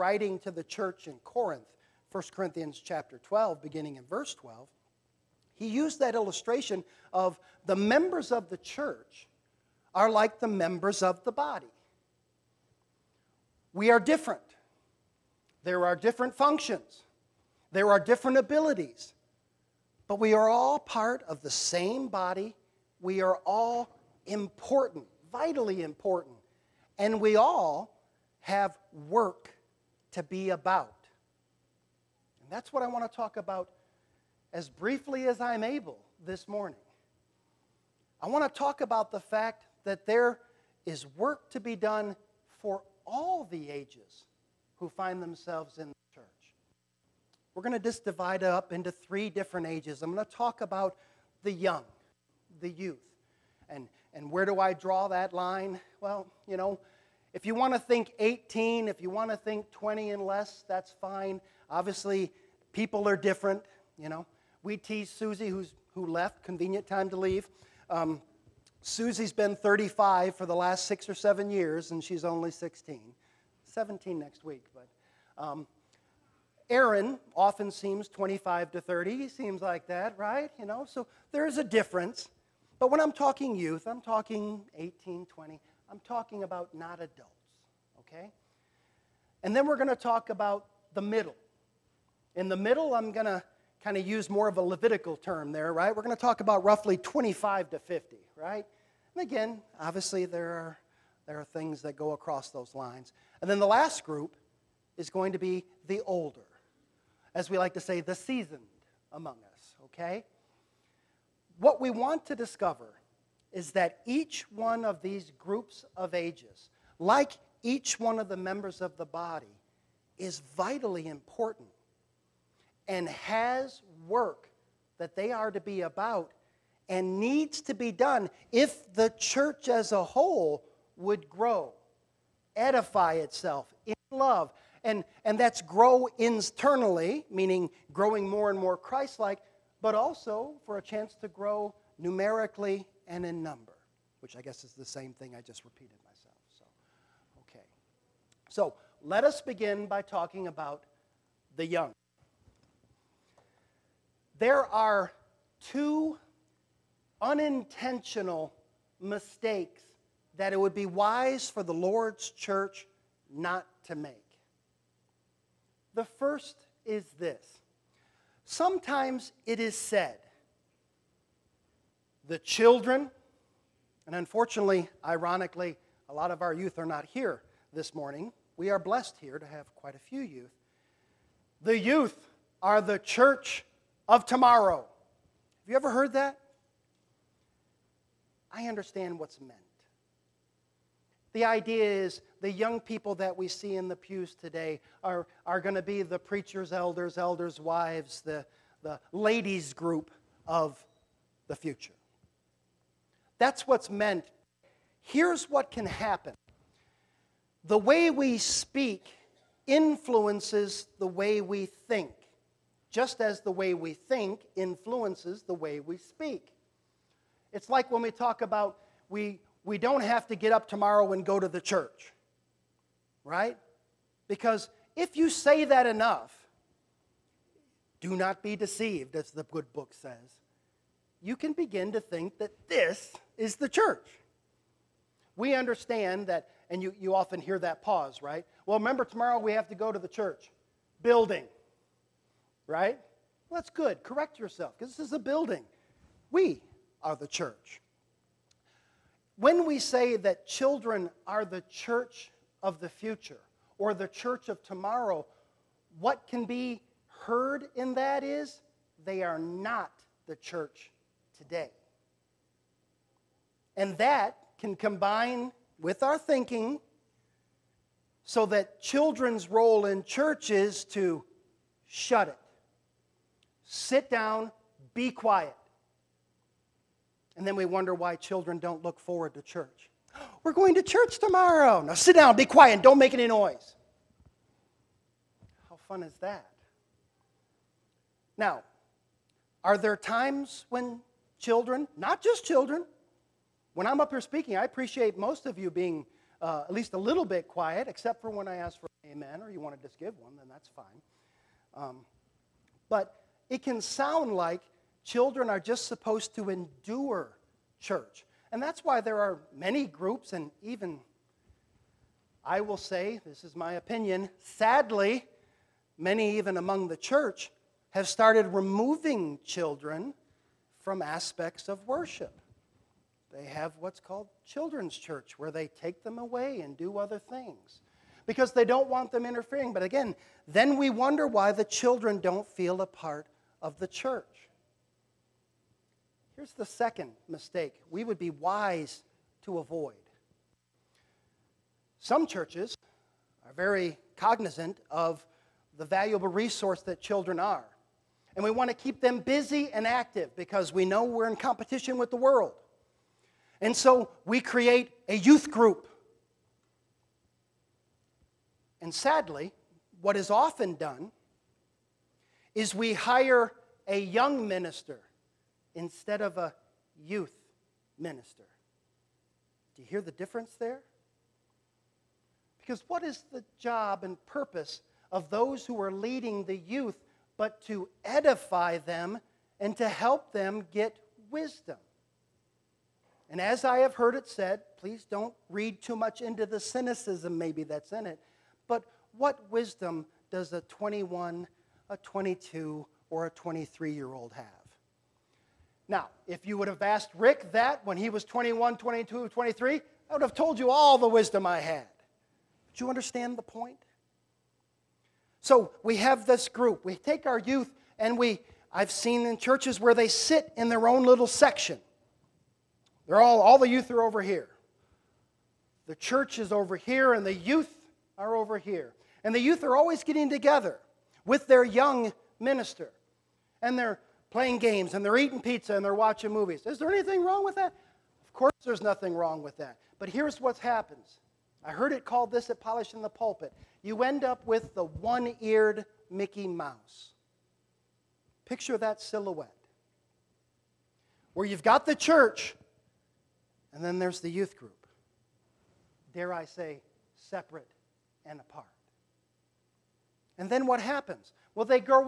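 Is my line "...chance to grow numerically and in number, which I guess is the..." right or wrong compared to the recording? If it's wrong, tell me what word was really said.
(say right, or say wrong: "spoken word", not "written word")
right.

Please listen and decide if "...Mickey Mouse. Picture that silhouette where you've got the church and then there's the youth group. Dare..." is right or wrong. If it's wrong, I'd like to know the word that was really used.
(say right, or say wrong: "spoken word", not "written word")
right.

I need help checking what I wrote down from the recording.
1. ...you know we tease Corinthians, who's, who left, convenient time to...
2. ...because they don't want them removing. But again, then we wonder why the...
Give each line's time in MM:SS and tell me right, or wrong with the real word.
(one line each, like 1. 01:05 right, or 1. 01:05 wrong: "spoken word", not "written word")
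1. 01:03 wrong: "Susie", not "Corinthians"
2. 05:28 wrong: "interfering", not "removing".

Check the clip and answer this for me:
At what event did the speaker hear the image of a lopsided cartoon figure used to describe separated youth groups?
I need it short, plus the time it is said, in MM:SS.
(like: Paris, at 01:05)
Polishing the Pulpit, at 07:12.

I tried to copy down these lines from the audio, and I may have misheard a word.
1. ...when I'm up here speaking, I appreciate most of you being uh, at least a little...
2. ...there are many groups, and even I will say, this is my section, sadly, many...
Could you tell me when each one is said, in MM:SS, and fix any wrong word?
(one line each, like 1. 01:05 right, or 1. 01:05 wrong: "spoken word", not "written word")
1. 04:53 right
2. 05:09 wrong: "opinion", not "section".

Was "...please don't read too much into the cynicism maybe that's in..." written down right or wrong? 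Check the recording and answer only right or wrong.
right.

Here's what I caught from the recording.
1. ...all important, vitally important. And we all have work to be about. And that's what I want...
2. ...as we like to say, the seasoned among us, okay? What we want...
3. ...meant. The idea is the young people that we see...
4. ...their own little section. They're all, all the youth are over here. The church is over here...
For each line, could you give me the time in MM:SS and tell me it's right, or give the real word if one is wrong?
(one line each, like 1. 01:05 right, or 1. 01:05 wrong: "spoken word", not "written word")
1. 00:23 right
2. 01:47 right
3. 03:09 right
4. 06:50 right.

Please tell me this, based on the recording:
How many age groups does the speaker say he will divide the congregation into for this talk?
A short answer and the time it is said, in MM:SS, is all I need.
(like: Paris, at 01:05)
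3, at 00:48.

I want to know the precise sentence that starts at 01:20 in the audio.
You know, so there is a difference.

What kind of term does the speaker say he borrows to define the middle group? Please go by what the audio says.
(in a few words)
Levitical.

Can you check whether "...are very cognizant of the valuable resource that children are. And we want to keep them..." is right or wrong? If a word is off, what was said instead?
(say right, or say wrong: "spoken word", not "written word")
right.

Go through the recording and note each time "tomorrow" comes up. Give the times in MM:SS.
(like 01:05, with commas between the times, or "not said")
03:04, 03:40, 03:59, 04:14, 04:41.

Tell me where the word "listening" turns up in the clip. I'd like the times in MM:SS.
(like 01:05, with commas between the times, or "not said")
not said.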